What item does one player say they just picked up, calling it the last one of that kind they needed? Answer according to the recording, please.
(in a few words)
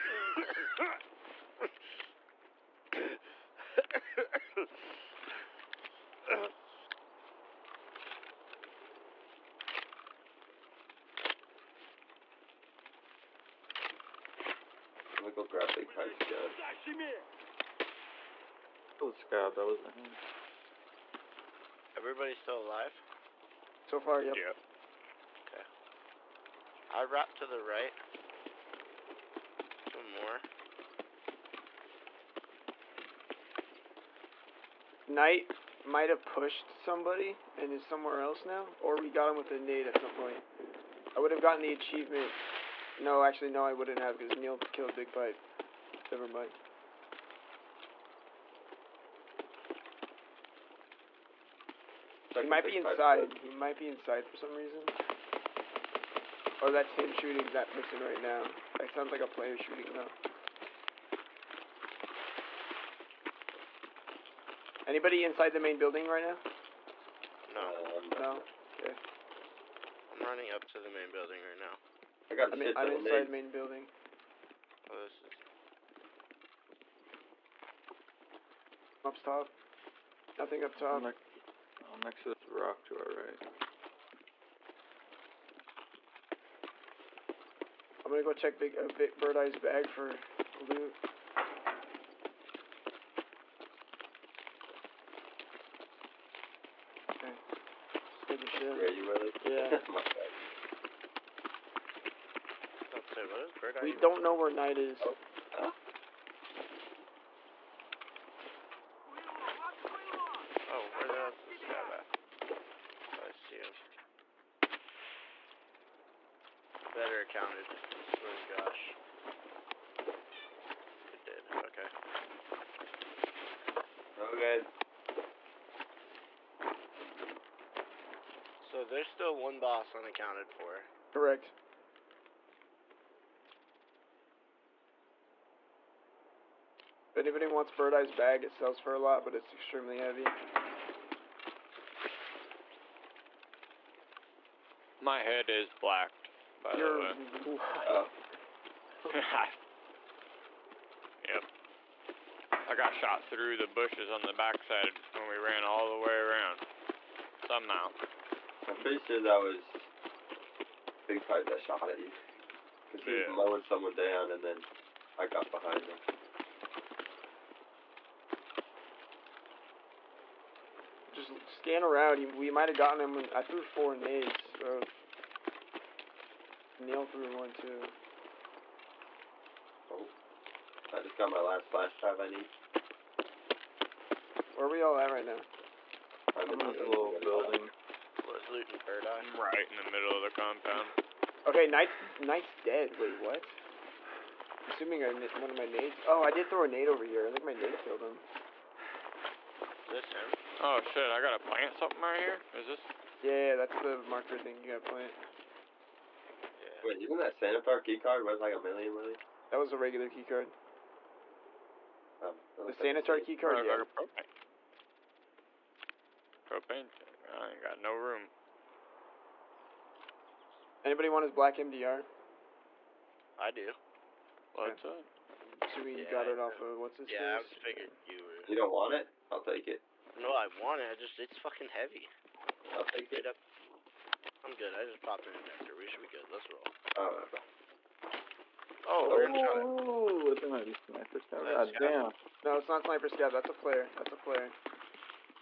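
flash drive.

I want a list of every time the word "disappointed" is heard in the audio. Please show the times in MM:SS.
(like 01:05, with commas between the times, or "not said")
not said.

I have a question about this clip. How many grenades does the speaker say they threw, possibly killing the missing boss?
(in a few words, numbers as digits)
4.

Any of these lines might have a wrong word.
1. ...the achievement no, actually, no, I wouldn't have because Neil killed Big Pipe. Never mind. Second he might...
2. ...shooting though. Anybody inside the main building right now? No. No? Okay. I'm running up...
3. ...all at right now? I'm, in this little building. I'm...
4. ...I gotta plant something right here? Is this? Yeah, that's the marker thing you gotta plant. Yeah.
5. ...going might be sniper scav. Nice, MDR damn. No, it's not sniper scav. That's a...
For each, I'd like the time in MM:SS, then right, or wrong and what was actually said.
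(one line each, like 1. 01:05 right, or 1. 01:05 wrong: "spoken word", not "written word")
1. 00:41 right
2. 00:59 right
3. 03:04 right
4. 03:21 right
5. 03:59 wrong: "God", not "MDR".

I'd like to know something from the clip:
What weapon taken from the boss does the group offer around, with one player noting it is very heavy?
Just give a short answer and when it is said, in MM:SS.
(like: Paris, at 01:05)
black MDR, at 03:41.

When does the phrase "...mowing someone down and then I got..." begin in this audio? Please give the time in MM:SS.
02:43.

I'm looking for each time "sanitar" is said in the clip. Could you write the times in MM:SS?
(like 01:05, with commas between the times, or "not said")
03:27, 03:32.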